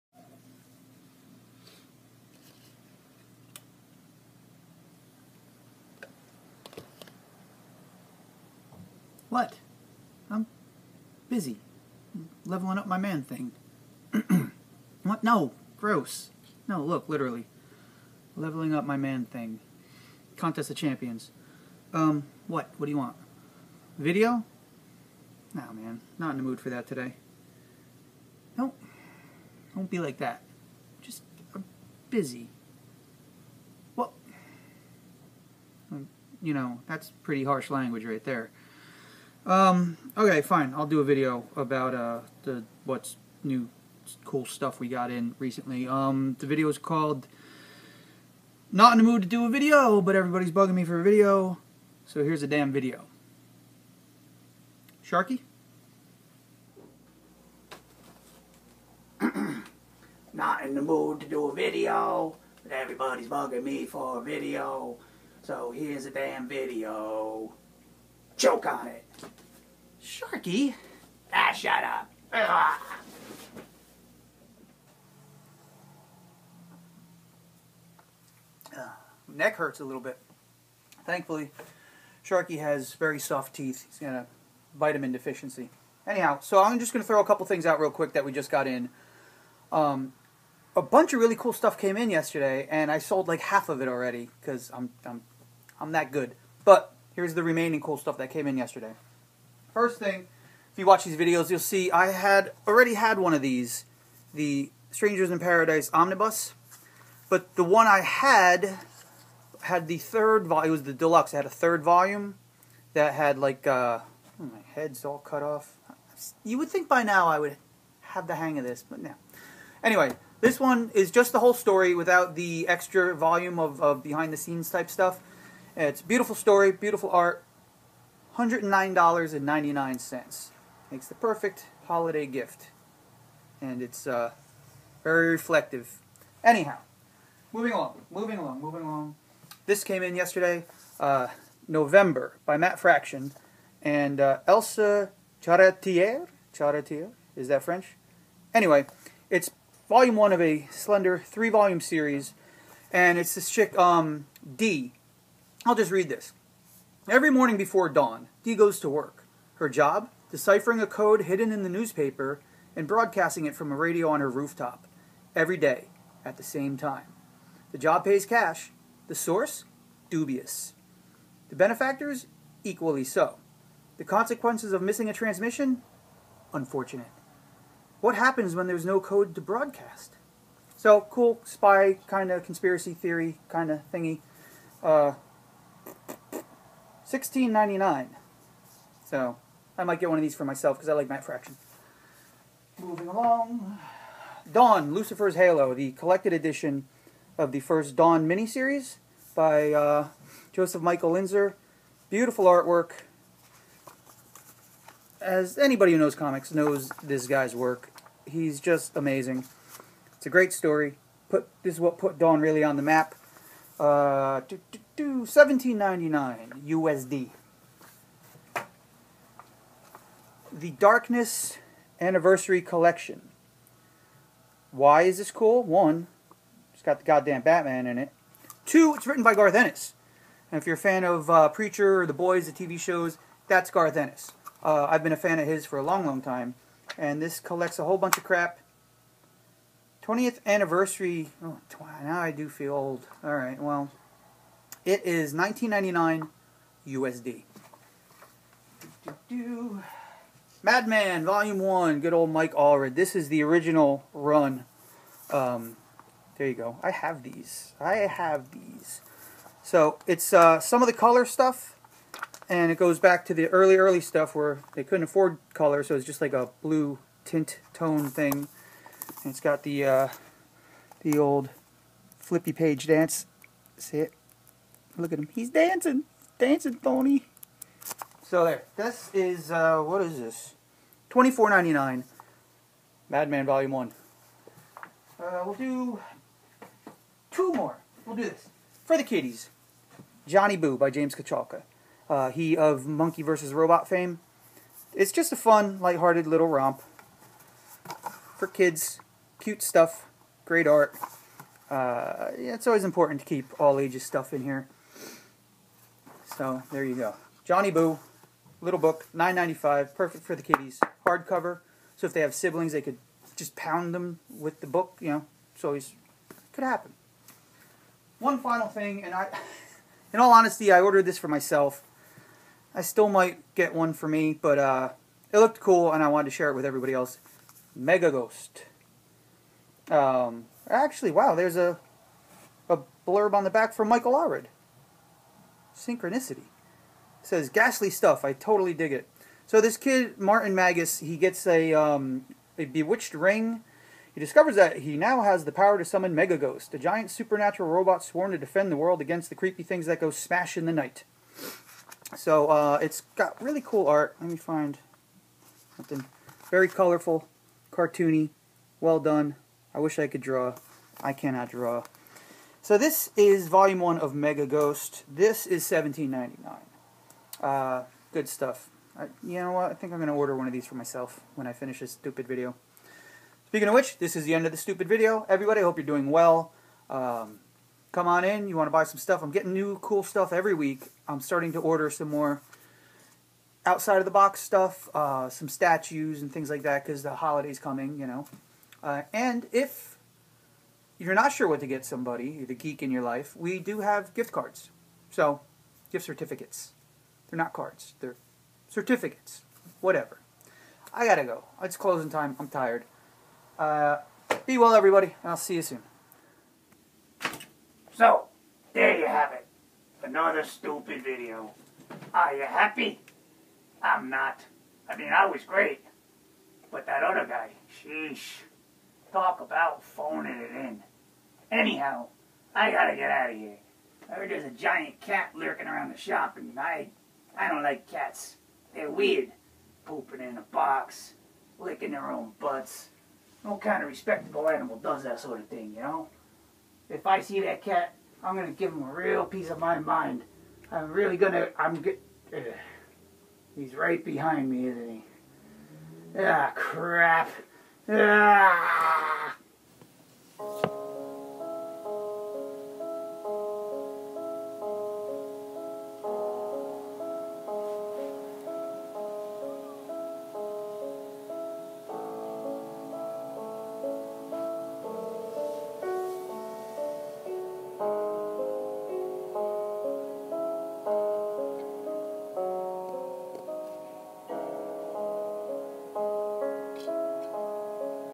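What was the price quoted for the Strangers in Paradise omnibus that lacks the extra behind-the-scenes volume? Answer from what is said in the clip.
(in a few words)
$109.99.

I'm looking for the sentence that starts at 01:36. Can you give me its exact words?
But here's the remaining cool stuff that came in yesterday.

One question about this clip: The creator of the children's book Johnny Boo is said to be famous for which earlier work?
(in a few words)
Monkey vs. Robot.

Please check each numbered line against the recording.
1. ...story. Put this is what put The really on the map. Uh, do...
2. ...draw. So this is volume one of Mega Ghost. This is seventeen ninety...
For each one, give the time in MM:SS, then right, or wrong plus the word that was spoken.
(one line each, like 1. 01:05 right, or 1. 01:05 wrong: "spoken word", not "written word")
1. 03:30 wrong: "Dawn", not "The"
2. 06:01 right.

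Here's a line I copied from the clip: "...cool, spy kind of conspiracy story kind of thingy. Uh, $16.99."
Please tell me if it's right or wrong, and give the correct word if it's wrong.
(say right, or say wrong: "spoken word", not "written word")
wrong: "theory", not "story".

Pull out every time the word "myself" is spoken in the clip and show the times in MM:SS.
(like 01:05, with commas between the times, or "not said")
03:10, 05:21, 06:10.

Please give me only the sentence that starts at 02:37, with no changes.
Every morning before dawn, Dee goes to work.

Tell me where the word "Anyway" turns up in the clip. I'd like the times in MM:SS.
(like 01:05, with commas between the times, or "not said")
01:59, 02:28.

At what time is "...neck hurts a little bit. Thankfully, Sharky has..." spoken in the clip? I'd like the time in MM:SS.
01:19.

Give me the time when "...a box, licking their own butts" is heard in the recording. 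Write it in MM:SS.
07:10.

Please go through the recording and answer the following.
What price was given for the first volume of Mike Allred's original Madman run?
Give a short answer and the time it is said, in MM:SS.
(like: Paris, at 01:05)
$24.99, at 04:41.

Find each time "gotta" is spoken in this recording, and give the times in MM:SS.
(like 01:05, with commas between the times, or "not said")
06:41, 07:02.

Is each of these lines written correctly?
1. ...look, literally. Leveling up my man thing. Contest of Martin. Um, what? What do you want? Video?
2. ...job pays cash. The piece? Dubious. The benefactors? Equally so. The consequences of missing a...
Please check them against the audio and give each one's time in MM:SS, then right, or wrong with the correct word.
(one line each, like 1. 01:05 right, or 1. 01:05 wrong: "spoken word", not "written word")
1. 00:16 wrong: "Champions", not "Martin"
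2. 02:47 wrong: "source", not "piece".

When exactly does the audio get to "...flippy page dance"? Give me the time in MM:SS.
04:32.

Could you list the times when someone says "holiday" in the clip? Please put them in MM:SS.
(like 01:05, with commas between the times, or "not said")
02:11, 06:27.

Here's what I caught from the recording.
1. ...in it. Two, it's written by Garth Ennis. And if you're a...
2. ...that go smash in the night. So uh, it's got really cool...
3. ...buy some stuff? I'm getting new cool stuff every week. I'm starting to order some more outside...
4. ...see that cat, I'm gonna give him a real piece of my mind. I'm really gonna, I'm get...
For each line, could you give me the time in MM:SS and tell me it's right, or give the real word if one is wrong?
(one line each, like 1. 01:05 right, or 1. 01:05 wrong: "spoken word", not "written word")
1. 03:47 right
2. 05:49 right
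3. 06:18 right
4. 07:17 right.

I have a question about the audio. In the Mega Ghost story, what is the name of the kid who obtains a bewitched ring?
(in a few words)
Martin Magus.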